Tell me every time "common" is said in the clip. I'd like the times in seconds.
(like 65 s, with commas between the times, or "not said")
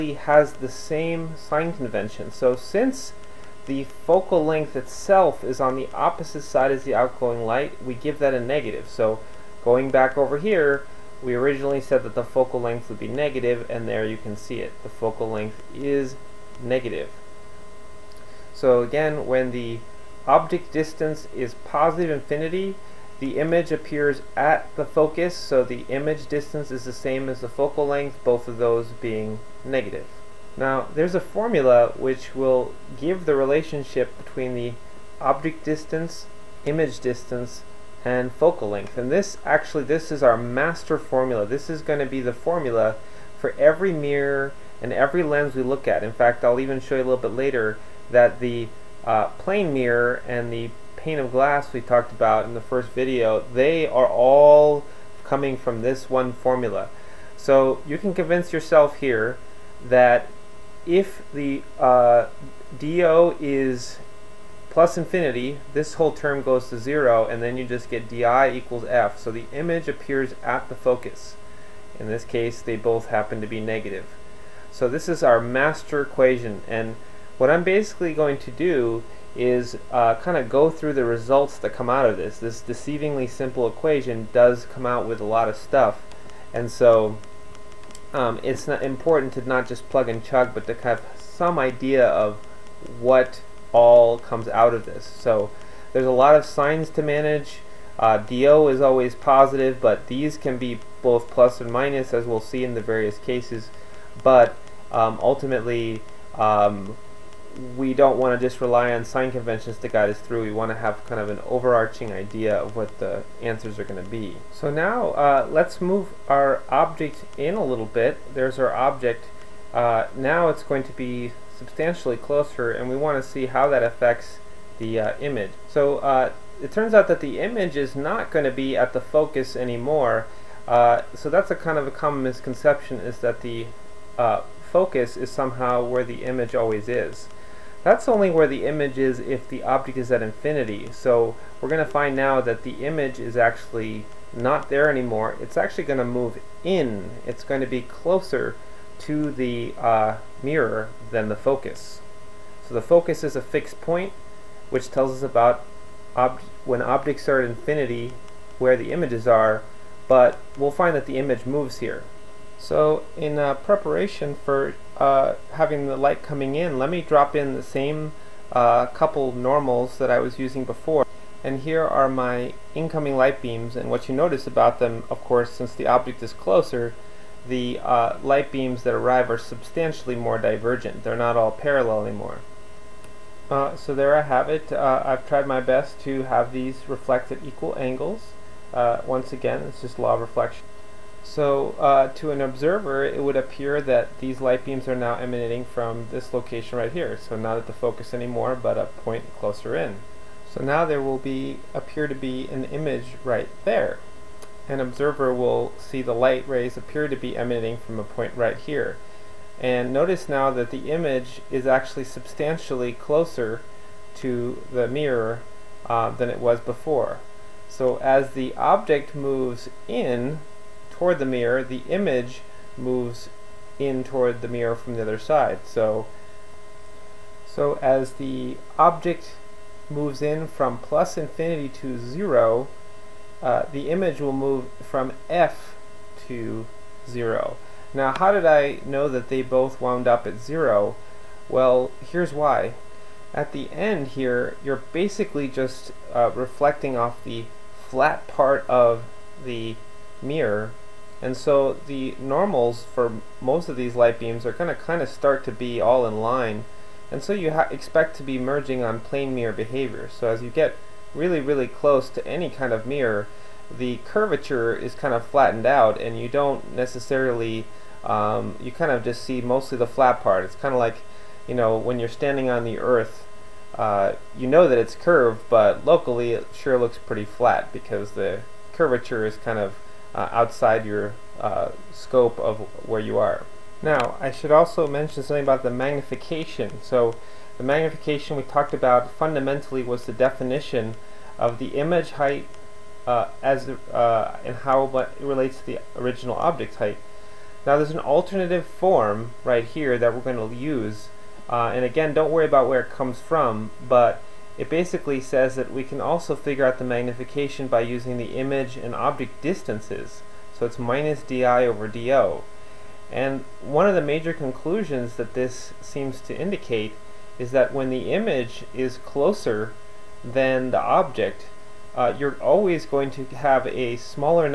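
131 s.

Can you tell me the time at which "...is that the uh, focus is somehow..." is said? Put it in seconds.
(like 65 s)
133 s.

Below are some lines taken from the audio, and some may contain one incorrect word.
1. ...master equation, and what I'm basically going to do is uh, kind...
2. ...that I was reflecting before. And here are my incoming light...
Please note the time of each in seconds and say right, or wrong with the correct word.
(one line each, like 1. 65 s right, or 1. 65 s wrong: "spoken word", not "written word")
1. 75 s right
2. 169 s wrong: "using", not "reflecting".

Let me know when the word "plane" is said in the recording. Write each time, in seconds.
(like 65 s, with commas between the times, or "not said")
49 s, 258 s.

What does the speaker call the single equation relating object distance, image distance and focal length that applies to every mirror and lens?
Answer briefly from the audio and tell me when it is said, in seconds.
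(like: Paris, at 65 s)
Master formula, at 40 s.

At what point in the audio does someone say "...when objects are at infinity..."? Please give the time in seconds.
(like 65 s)
156 s.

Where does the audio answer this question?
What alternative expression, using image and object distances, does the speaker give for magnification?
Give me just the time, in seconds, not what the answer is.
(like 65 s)
310 s.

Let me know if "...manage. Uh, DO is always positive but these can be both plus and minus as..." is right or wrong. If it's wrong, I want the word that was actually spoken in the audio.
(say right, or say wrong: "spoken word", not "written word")
right.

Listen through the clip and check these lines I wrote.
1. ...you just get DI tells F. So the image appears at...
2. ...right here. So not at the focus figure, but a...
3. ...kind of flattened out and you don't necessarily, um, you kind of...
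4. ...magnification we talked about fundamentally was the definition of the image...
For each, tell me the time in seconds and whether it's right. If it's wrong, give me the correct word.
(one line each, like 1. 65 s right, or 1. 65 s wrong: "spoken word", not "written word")
1. 67 s wrong: "equals", not "tells"
2. 196 s wrong: "anymore", not "figure"
3. 264 s right
4. 287 s right.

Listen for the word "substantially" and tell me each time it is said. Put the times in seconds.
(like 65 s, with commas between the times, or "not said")
121 s, 179 s, 212 s.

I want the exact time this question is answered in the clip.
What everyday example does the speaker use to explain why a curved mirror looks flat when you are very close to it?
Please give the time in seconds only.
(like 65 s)
272 s.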